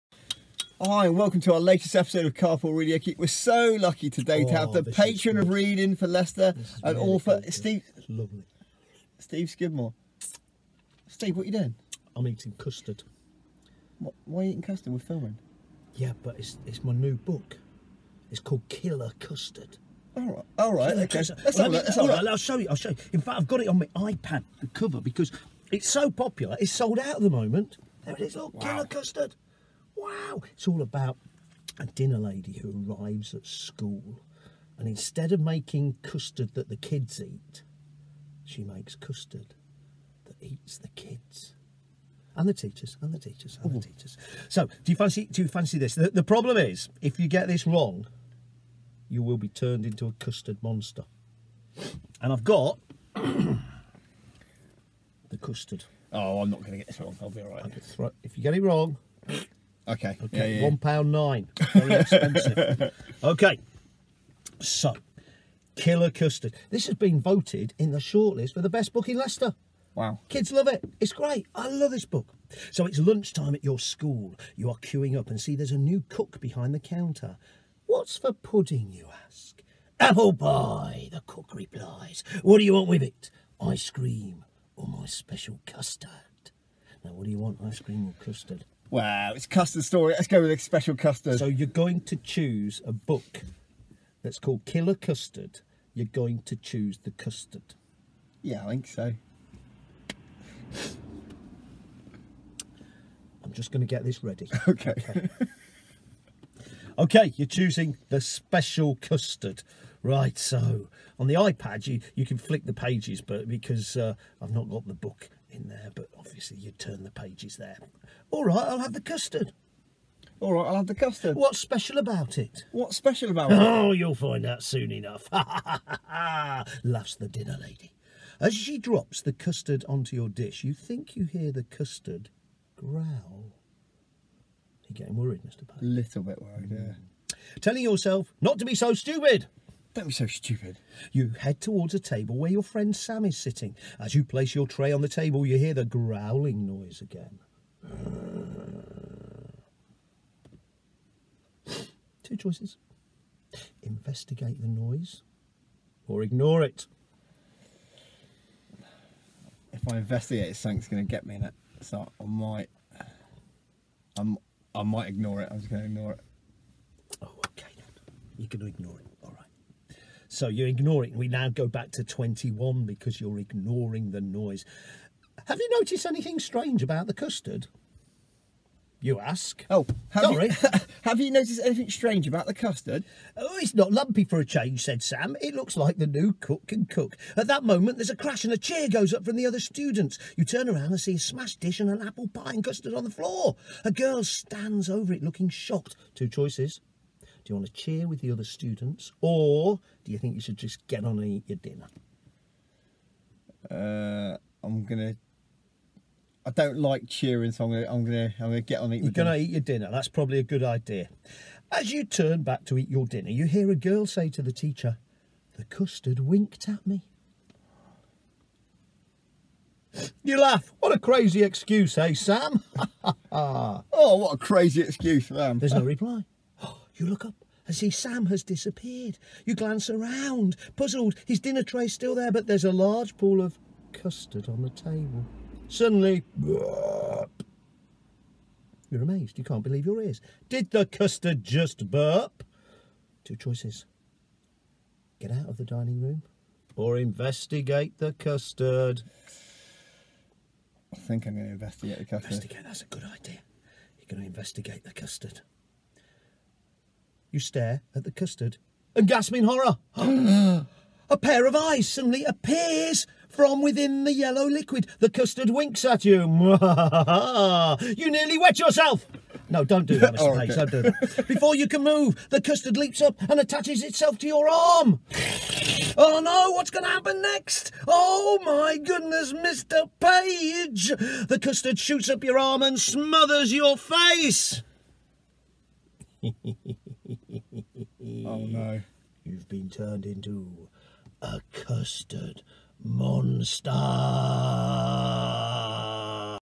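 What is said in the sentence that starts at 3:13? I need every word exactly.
A girl stands over it looking shocked.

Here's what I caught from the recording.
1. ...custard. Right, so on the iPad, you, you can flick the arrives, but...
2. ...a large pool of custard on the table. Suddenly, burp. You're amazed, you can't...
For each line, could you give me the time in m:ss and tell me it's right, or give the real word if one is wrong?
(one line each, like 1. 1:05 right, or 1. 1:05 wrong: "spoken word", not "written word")
1. 1:48 wrong: "pages", not "arrives"
2. 3:52 right.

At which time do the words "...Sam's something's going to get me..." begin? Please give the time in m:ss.
2:40.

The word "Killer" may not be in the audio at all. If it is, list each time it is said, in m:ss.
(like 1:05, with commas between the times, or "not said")
0:18, 0:28, 1:05, 1:34.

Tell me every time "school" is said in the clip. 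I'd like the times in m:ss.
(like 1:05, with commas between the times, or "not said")
0:33, 1:13.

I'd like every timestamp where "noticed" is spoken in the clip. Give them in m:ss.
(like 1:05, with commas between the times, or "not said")
2:55, 3:01.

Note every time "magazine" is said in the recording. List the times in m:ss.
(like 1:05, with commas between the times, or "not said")
not said.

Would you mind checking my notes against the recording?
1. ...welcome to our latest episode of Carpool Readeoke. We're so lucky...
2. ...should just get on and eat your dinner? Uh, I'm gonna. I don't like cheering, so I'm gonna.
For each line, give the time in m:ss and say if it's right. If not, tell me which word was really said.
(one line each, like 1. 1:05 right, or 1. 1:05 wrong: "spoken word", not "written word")
1. 0:01 right
2. 3:20 right.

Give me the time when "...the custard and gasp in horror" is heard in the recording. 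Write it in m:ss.
4:18.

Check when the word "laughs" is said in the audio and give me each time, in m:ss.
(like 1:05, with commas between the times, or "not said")
2:05, 3:40.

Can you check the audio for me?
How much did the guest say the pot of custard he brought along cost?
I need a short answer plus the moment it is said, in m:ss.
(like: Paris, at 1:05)
One pound nine, at 1:00.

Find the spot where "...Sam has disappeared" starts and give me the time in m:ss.
3:47.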